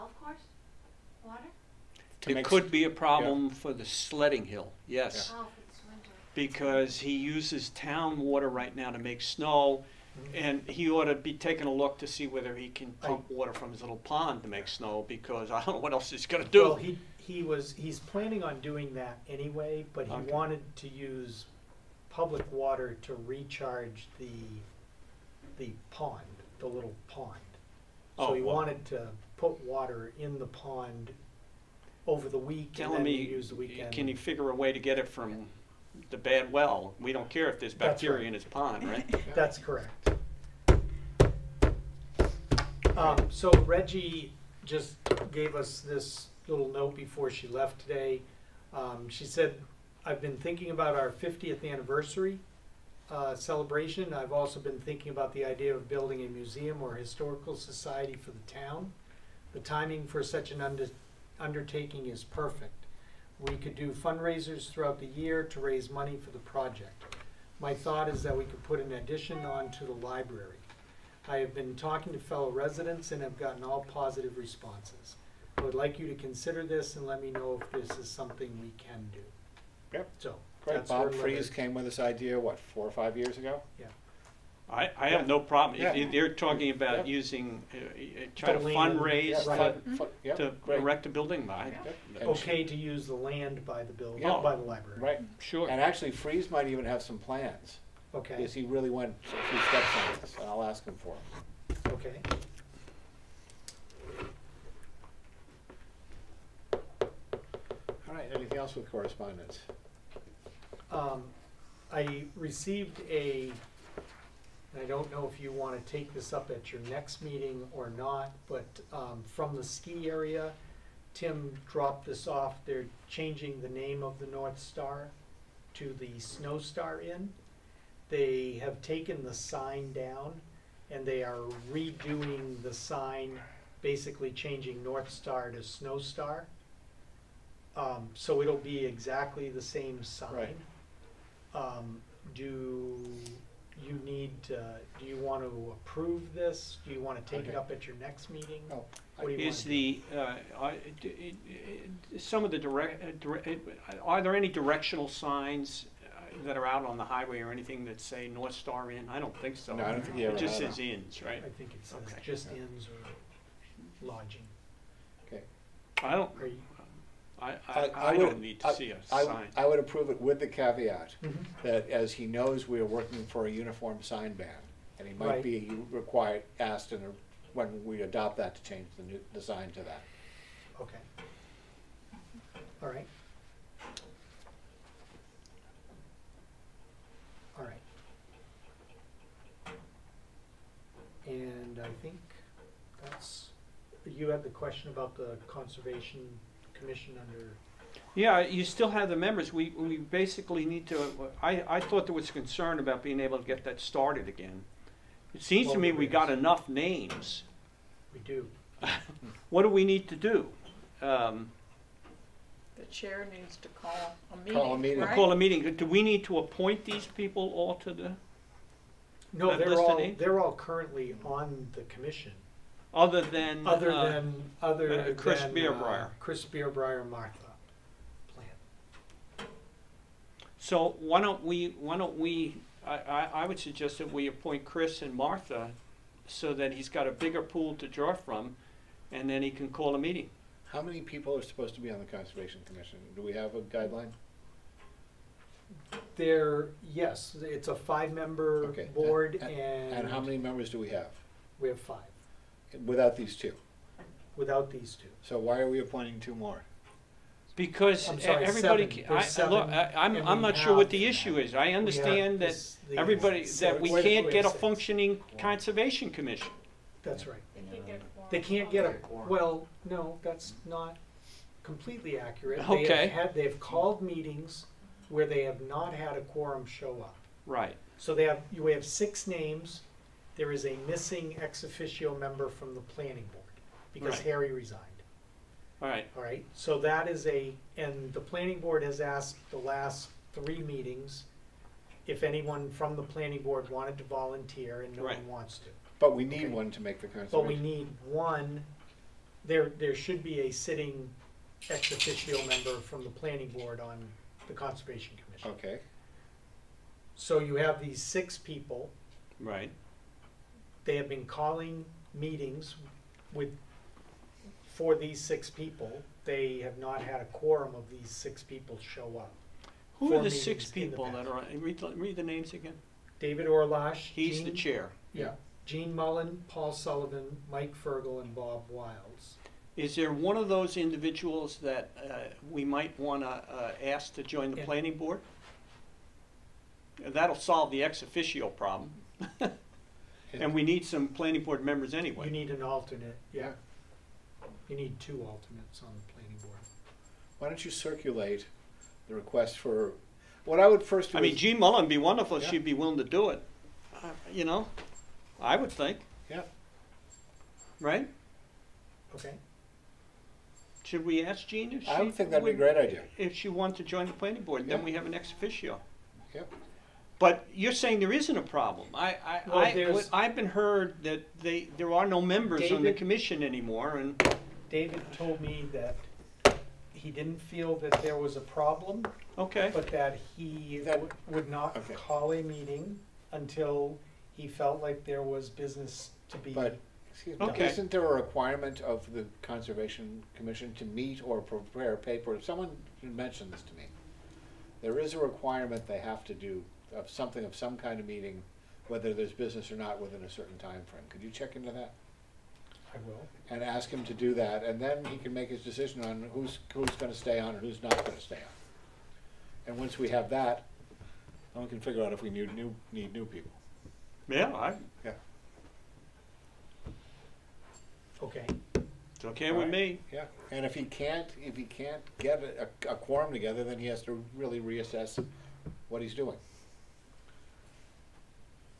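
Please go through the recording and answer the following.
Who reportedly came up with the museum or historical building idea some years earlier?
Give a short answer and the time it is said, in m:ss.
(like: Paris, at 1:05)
Bob Freeze, at 1:20.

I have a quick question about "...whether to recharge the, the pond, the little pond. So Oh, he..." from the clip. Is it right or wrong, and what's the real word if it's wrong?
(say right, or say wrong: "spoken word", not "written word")
wrong: "water", not "whether".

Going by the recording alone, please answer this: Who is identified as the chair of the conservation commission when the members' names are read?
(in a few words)
David Orlach.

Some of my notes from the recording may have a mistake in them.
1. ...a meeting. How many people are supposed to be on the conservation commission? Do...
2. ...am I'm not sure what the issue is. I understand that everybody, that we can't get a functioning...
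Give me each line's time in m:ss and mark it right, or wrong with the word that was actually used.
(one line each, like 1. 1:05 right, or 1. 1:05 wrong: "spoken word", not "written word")
1. 3:59 right
2. 4:20 right.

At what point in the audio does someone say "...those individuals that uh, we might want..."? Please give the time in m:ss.
5:30.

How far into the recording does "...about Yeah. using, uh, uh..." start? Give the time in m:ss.
1:26.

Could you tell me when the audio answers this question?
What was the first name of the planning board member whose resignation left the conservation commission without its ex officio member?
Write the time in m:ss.
4:44.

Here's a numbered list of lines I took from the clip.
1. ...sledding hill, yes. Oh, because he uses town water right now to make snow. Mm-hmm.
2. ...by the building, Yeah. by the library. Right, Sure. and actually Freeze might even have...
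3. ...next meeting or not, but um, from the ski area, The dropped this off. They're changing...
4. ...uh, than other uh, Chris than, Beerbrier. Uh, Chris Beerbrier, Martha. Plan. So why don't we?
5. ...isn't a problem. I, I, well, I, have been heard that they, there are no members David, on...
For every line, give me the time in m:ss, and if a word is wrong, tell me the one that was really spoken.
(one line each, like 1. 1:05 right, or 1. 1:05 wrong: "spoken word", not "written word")
1. 0:03 right
2. 1:33 right
3. 1:56 wrong: "Tim", not "The"
4. 3:43 right
5. 6:08 right.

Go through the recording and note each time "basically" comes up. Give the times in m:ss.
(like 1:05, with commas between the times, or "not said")
2:13, 3:19.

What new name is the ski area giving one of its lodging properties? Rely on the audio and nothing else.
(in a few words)
Snow Star Inn.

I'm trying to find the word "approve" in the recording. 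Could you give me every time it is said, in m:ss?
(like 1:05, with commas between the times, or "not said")
2:25, 2:49.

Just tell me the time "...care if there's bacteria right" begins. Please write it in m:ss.
0:37.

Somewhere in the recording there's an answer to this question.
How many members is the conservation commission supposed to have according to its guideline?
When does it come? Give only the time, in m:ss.
4:07.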